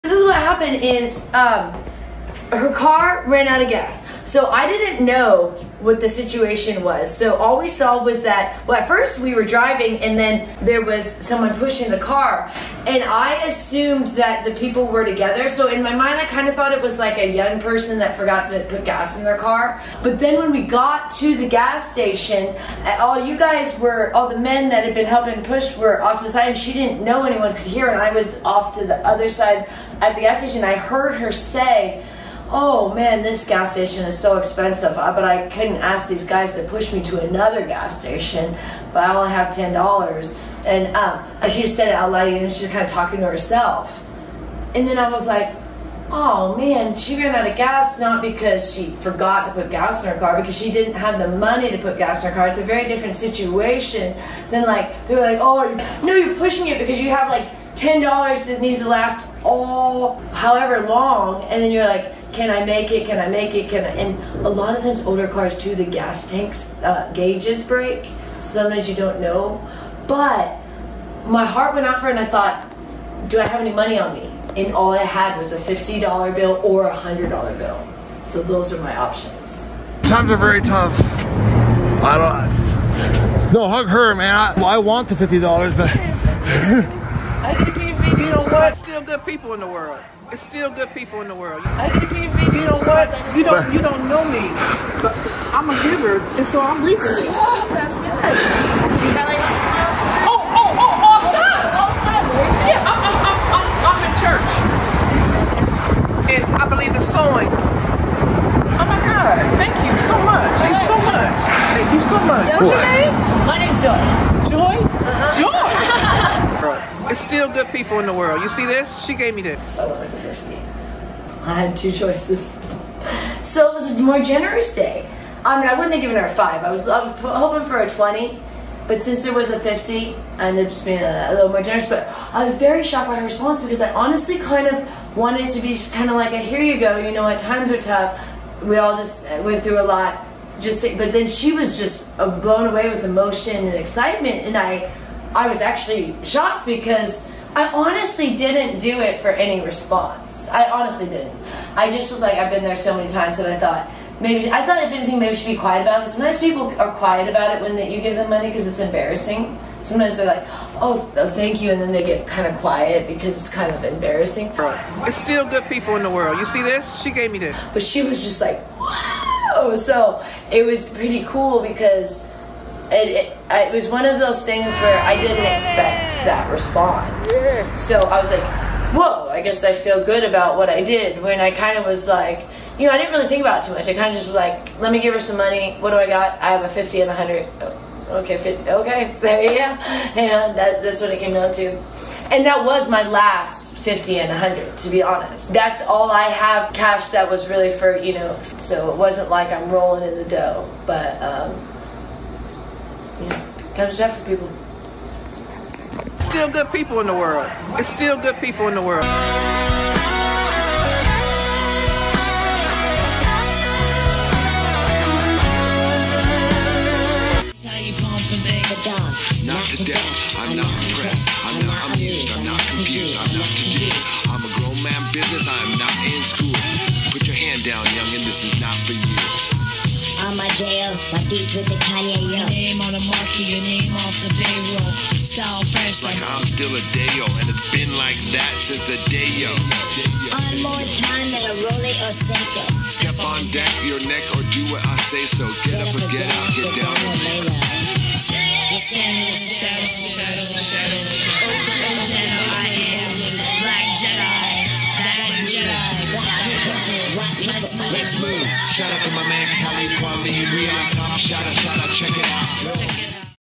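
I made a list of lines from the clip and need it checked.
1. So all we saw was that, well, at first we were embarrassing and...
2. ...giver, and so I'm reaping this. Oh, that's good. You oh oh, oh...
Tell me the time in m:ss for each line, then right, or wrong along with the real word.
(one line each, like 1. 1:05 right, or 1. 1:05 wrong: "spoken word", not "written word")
1. 0:07 wrong: "driving", not "embarrassing"
2. 1:35 right.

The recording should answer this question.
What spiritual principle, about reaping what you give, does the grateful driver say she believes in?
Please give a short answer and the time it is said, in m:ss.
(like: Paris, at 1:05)
sowing, at 1:47.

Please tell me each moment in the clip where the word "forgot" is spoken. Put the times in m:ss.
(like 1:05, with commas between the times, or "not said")
0:18, 0:48.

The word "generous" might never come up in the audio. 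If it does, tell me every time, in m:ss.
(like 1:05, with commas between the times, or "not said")
2:04, 2:11.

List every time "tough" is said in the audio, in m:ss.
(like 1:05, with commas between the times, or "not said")
1:20, 2:17.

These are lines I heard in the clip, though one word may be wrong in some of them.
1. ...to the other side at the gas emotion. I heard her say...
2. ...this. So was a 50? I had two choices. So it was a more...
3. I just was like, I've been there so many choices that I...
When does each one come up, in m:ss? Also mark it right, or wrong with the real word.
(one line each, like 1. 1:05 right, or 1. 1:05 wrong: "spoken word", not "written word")
1. 0:28 wrong: "station", not "emotion"
2. 1:59 right
3. 2:31 wrong: "times", not "choices".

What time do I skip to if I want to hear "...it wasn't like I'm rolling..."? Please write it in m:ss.
3:18.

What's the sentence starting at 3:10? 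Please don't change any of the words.
You know, that, that's what it came down to.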